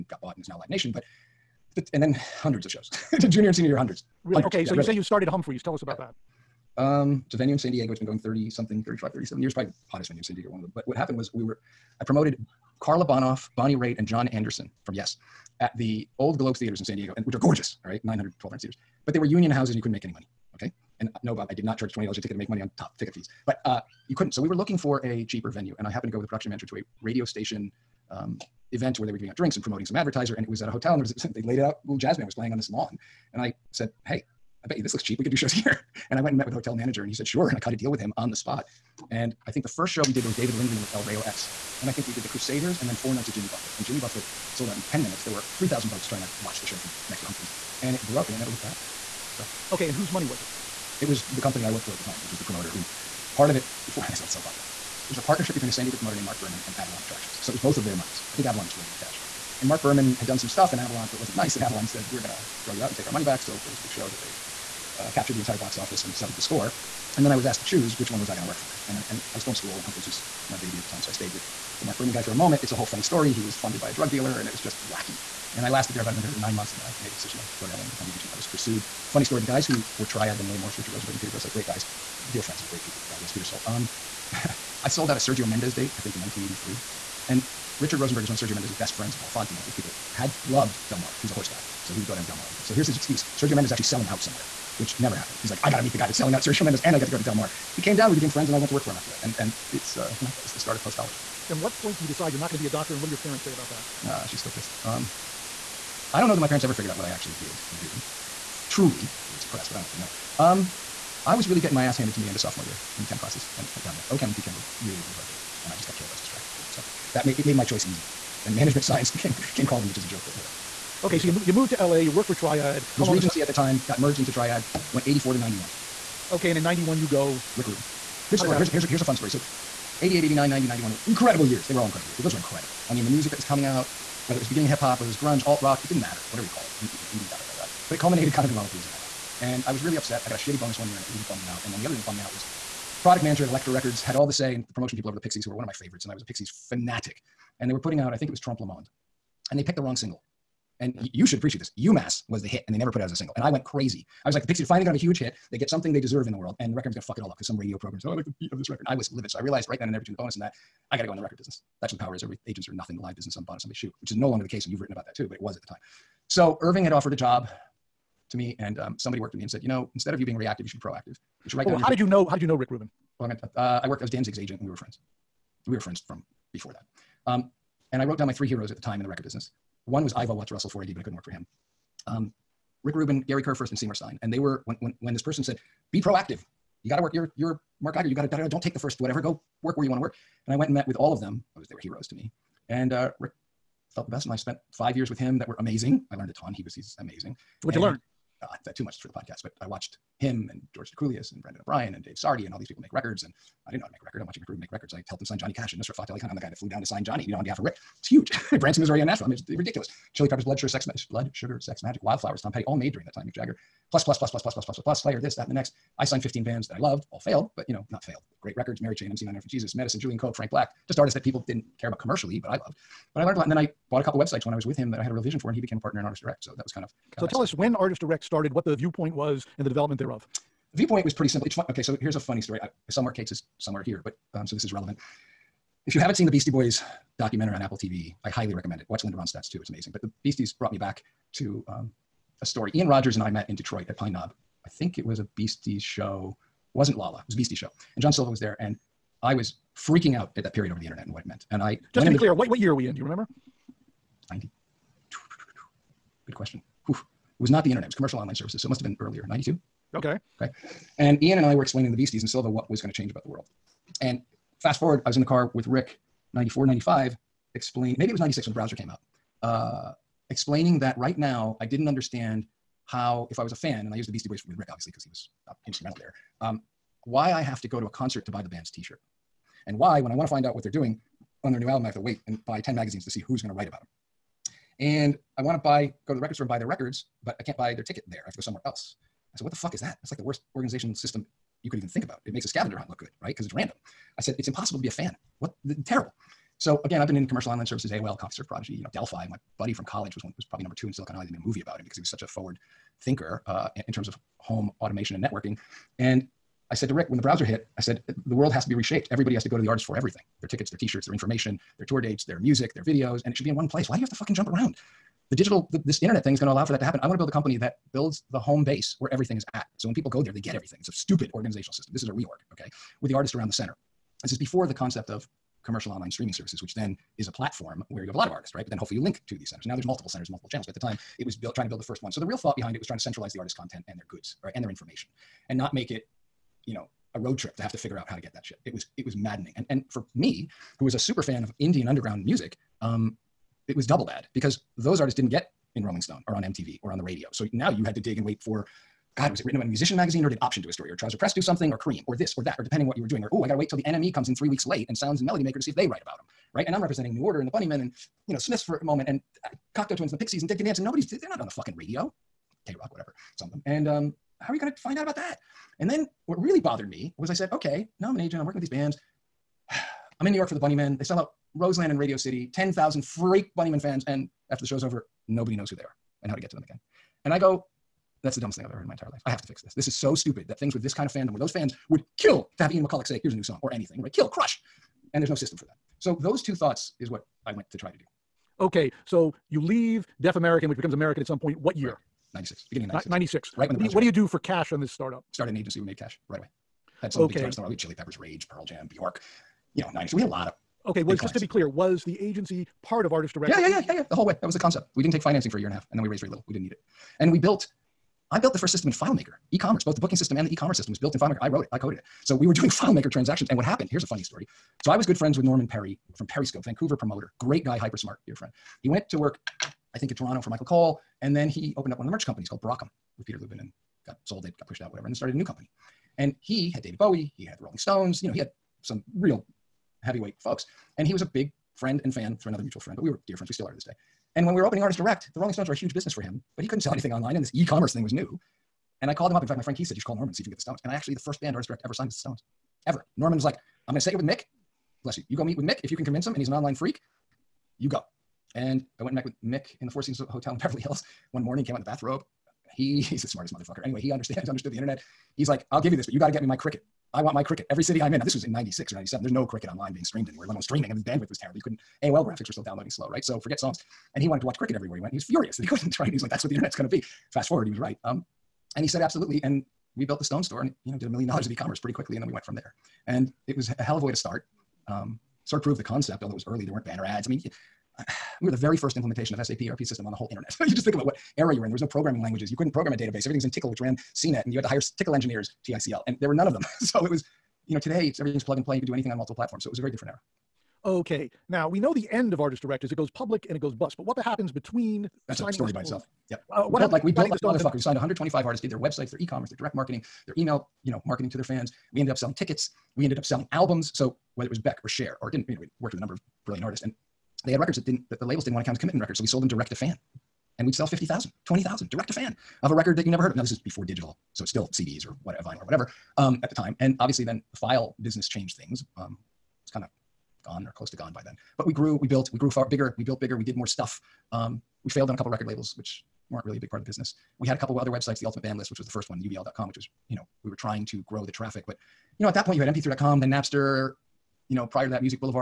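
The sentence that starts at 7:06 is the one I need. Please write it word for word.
And he had David Bowie, he had the Rolling Stones, you know, he had some real heavyweight folks.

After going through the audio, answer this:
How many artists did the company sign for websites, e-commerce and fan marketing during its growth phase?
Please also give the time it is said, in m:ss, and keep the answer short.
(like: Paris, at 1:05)
125, at 8:17.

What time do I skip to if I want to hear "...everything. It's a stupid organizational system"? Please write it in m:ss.
5:20.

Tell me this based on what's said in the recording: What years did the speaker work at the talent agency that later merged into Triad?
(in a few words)
1984 to 1991.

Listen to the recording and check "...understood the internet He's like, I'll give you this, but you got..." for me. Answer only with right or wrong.
right.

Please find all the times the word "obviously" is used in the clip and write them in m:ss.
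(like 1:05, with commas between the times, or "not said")
4:34, 8:36.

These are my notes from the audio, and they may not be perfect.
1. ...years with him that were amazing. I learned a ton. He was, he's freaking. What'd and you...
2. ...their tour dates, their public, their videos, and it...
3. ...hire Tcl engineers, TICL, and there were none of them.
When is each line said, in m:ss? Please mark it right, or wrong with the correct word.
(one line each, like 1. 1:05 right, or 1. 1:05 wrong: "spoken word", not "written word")
1. 3:14 wrong: "amazing", not "freaking"
2. 5:11 wrong: "music", not "public"
3. 8:04 right.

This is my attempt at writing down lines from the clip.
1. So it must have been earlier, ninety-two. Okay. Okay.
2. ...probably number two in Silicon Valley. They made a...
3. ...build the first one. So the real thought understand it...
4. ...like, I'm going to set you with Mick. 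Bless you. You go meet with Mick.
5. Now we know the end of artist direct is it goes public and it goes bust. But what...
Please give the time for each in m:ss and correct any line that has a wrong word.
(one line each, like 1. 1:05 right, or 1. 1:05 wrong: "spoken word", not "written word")
1. 4:18 right
2. 5:00 right
3. 5:31 wrong: "behind", not "understand"
4. 7:23 right
5. 8:11 right.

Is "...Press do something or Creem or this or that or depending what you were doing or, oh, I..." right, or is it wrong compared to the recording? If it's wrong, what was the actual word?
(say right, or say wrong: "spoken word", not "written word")
right.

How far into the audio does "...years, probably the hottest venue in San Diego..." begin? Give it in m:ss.
0:09.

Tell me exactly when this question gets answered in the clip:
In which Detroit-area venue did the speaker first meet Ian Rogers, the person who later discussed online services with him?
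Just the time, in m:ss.
4:03.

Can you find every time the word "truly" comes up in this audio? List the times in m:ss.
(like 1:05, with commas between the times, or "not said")
1:48.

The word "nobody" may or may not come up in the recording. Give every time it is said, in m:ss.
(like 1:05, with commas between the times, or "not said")
6:00, 6:15.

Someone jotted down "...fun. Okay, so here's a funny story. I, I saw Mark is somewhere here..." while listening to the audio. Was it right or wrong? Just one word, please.
right.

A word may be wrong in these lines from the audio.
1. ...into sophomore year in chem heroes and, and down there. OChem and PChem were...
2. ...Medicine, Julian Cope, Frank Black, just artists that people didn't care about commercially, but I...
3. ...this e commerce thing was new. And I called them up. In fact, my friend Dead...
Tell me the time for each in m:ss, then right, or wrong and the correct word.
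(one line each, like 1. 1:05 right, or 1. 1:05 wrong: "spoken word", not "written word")
1. 1:52 wrong: "classes", not "heroes"
2. 3:39 right
3. 7:17 wrong: "Keith", not "Dead".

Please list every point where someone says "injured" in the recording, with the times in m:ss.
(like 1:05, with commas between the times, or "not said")
not said.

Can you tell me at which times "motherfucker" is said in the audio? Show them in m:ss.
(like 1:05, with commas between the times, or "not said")
7:33, 8:17.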